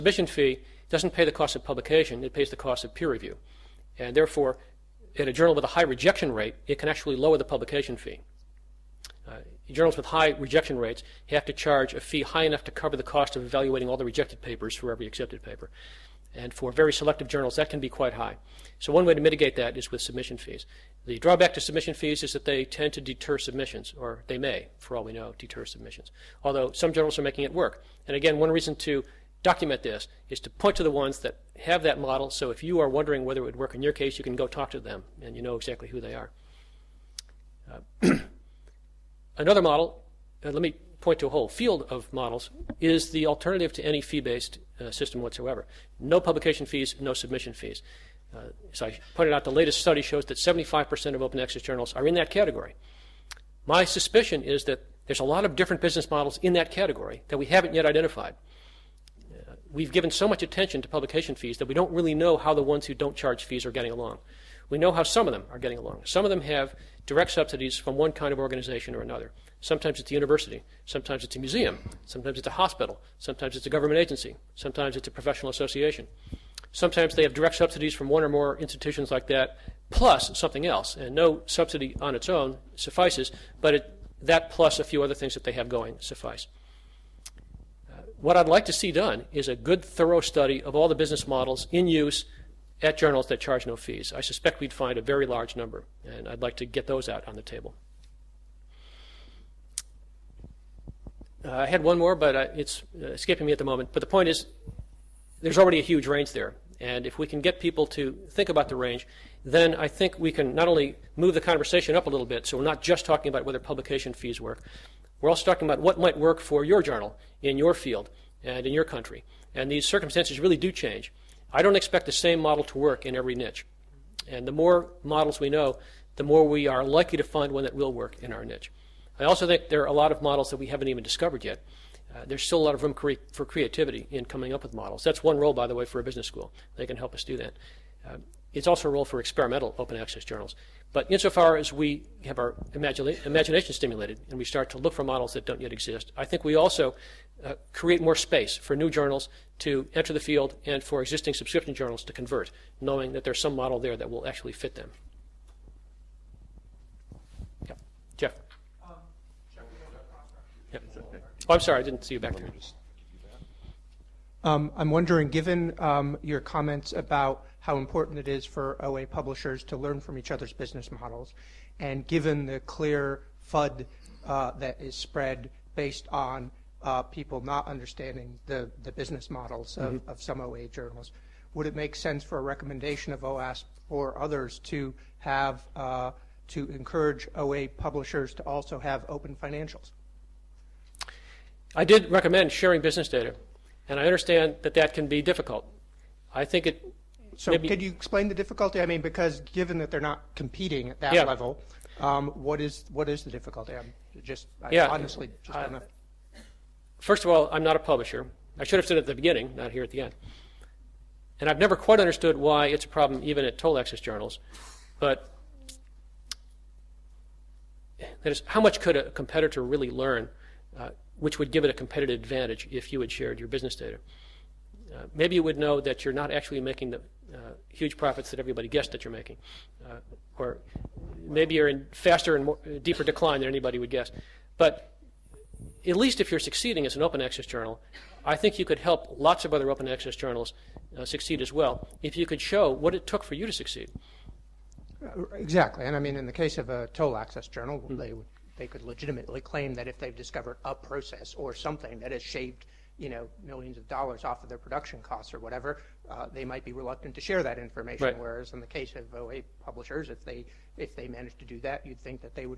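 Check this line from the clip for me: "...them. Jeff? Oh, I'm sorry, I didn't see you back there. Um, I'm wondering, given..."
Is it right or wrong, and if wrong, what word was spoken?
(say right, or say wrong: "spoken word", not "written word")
right.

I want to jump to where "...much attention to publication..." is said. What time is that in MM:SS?
01:00.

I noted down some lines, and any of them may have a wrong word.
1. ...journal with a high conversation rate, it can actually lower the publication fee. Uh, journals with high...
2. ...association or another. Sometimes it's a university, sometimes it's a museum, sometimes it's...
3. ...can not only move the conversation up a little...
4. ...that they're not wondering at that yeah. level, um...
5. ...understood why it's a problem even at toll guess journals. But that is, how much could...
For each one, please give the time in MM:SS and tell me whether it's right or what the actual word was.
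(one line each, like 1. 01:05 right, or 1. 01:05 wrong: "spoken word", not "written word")
1. 00:05 wrong: "rejection", not "conversation"
2. 01:08 wrong: "organization", not "association"
3. 01:50 right
4. 03:19 wrong: "competing", not "wondering"
5. 03:31 wrong: "access", not "guess".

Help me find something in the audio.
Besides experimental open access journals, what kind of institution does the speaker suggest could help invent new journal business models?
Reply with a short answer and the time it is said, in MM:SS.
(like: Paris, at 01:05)
business school, at 02:16.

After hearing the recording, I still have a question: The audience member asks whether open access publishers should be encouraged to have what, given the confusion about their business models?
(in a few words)
open financials.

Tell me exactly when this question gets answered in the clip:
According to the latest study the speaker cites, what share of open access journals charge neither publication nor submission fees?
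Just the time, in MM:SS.
00:50.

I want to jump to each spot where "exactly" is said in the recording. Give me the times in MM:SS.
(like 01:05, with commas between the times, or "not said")
00:35, 04:05.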